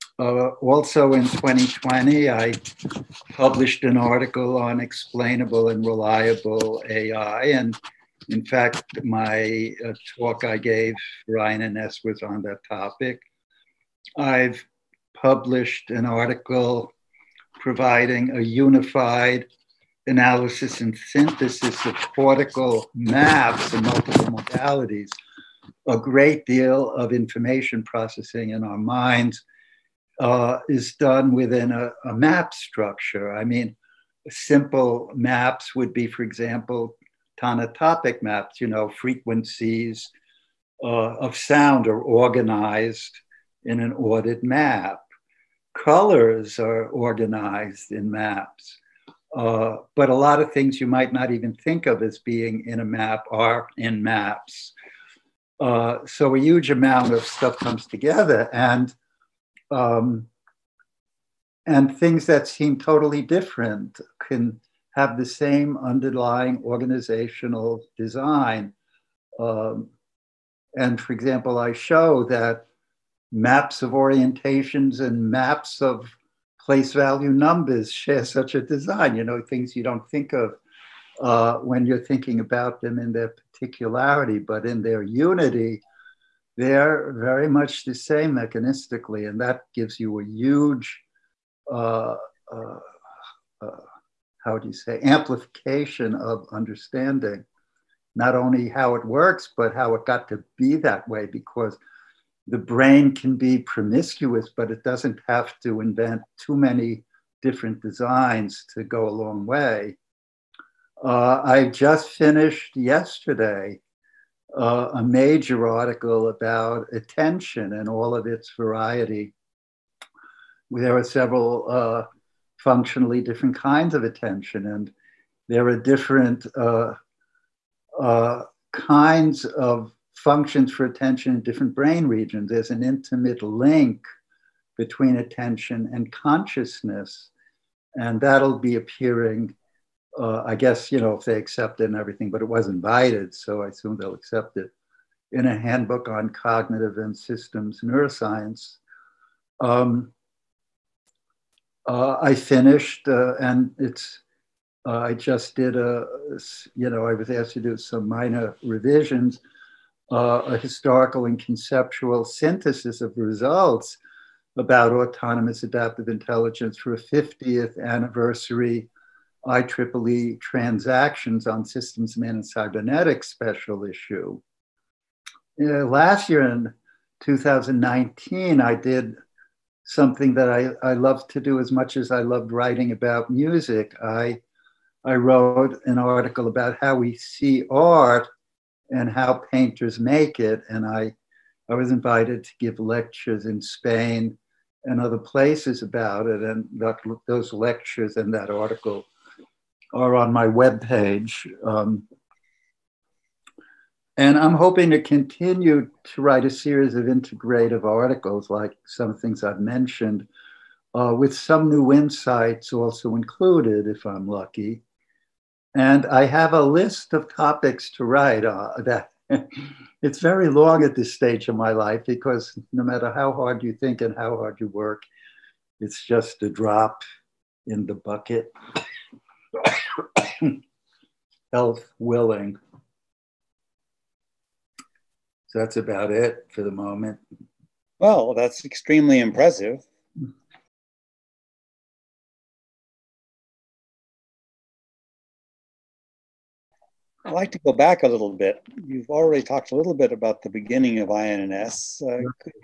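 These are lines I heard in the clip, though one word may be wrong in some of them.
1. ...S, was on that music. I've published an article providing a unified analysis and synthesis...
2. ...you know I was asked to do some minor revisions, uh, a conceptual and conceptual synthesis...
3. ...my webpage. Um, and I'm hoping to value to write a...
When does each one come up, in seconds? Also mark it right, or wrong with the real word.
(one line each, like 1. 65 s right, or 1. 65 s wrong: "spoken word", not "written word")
1. 11 s wrong: "topic", not "music"
2. 156 s wrong: "historical", not "conceptual"
3. 200 s wrong: "continue", not "value".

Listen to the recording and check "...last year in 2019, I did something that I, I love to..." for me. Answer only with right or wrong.
right.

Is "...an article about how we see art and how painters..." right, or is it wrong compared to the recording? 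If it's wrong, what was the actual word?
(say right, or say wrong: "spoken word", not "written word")
right.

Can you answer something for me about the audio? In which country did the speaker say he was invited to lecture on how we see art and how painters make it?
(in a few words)
Spain.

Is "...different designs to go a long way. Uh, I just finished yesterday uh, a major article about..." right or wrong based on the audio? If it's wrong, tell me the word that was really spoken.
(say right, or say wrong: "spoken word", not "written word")
right.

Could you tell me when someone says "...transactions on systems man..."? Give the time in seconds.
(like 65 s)
170 s.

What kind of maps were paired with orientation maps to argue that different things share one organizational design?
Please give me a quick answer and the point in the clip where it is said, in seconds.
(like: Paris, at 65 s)
place value numbers, at 76 s.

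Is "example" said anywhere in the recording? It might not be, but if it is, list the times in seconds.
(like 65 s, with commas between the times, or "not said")
36 s, 71 s.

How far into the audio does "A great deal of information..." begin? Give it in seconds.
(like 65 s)
25 s.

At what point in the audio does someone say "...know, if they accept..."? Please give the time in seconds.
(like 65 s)
141 s.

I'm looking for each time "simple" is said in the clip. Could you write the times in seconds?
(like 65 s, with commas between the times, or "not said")
34 s.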